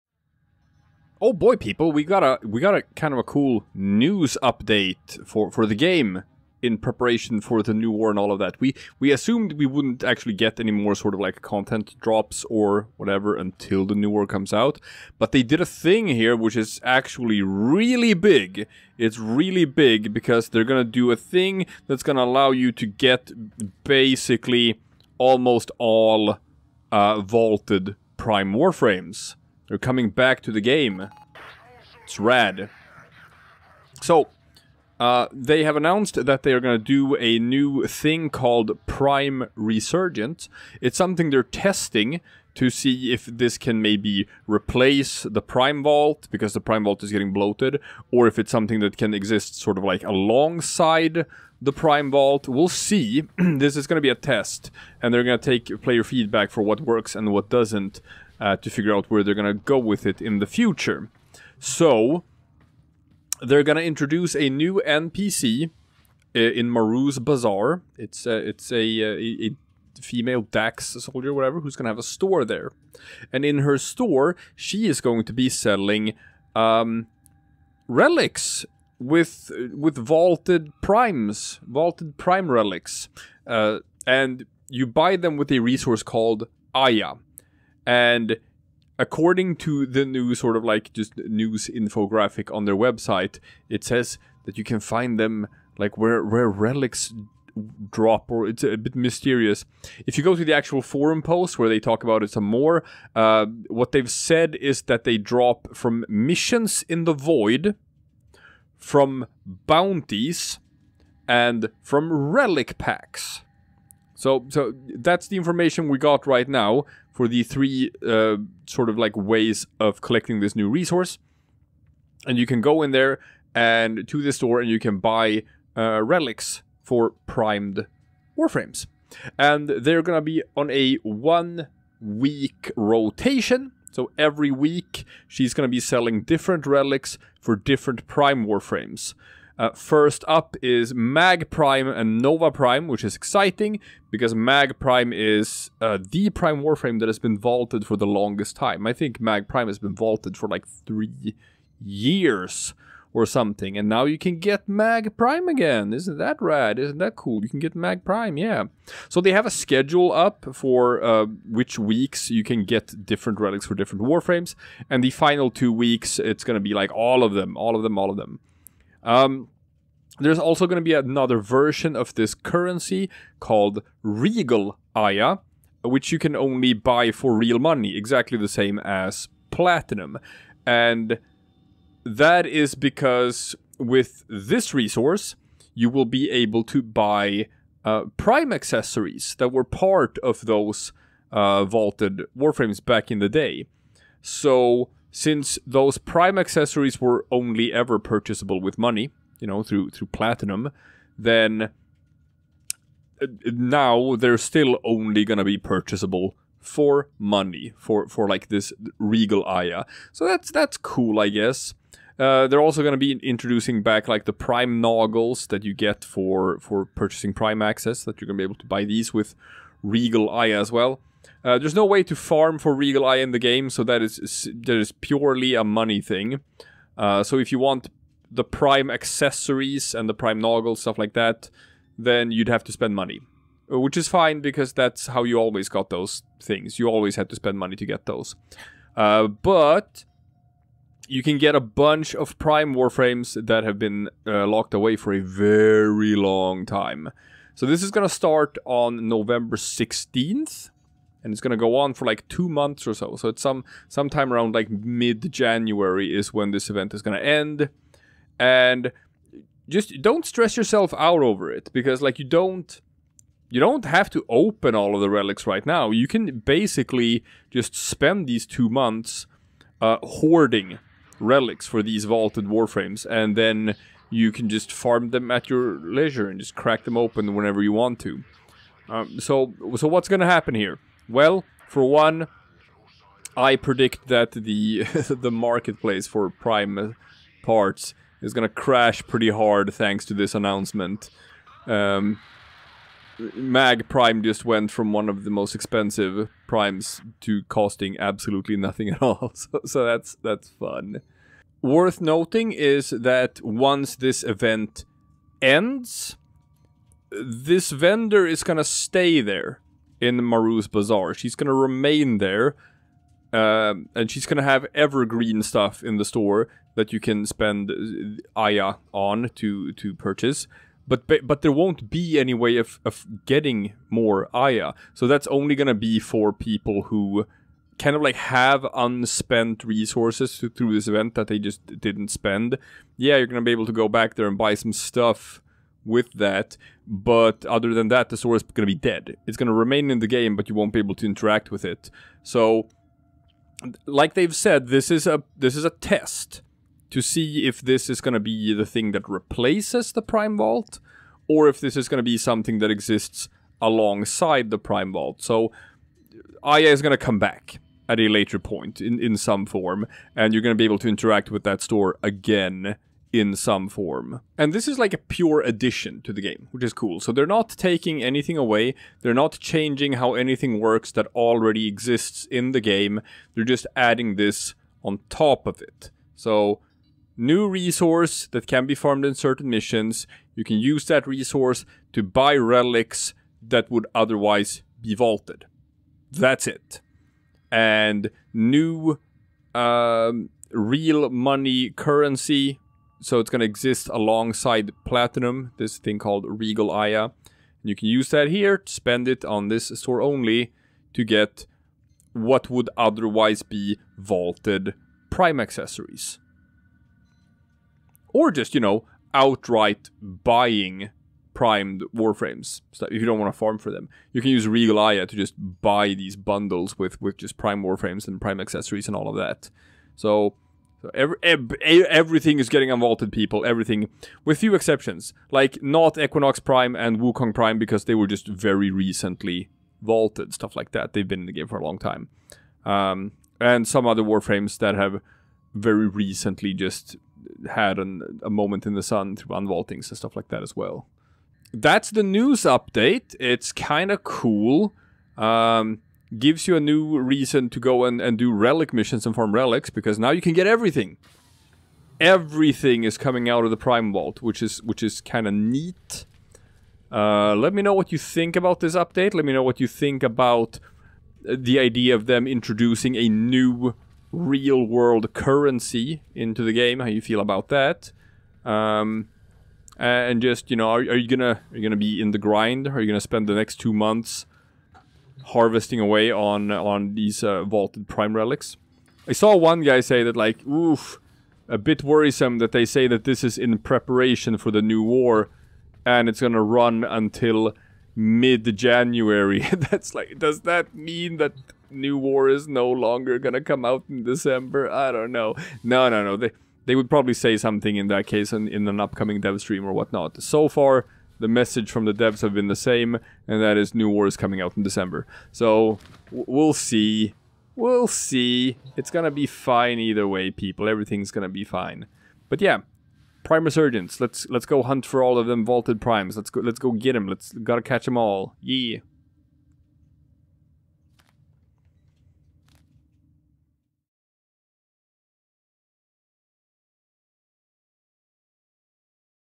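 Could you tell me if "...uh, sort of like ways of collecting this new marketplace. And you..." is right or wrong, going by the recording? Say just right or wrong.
wrong.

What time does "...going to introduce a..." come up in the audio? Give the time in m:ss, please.
1:03.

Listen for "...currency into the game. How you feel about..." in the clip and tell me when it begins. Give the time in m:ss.
7:45.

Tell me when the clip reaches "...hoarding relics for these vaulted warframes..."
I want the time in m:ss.
4:30.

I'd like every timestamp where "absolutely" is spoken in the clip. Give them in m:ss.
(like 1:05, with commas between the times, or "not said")
4:57.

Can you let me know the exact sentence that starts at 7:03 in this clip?
Everything, with few exceptions, like not Equinox Prime and Wukong Prime because they were just very recently vaulted, stuff like that.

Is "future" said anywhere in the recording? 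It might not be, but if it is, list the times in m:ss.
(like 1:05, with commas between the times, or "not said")
1:00.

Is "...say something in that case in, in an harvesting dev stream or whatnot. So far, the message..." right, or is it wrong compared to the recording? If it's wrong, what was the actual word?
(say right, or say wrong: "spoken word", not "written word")
wrong: "upcoming", not "harvesting".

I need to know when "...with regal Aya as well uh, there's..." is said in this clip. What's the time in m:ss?
3:39.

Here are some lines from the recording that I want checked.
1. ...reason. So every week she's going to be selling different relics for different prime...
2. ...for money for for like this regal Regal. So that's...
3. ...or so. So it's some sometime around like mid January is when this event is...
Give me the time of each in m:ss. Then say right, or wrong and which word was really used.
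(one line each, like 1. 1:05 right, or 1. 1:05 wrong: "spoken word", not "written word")
1. 2:12 wrong: "rotation", not "reason"
2. 3:26 wrong: "Aya", not "Regal"
3. 4:12 right.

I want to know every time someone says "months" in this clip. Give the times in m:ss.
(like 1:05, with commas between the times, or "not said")
4:12, 4:28, 7:53.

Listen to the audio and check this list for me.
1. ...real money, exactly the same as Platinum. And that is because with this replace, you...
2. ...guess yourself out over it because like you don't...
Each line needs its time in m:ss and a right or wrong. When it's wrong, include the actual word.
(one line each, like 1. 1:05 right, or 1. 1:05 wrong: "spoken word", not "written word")
1. 2:57 wrong: "resource", not "replace"
2. 4:20 wrong: "stress", not "guess".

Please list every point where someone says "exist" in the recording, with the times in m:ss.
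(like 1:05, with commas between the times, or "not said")
0:49, 5:52, 6:11, 6:33.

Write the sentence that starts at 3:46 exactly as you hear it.
Uh, so if you want the prime accessories and the prime noggles, stuff like that, then you'd have to spend money.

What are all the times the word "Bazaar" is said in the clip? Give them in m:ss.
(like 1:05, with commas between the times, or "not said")
1:07, 5:10.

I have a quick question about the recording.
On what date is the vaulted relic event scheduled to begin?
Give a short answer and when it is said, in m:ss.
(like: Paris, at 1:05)
November 16th, at 4:09.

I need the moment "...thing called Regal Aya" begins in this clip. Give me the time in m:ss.
6:35.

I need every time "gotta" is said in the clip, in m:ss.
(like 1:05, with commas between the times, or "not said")
8:37.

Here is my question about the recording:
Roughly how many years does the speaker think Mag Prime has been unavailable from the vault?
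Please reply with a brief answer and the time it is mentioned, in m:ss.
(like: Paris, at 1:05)
3, at 2:30.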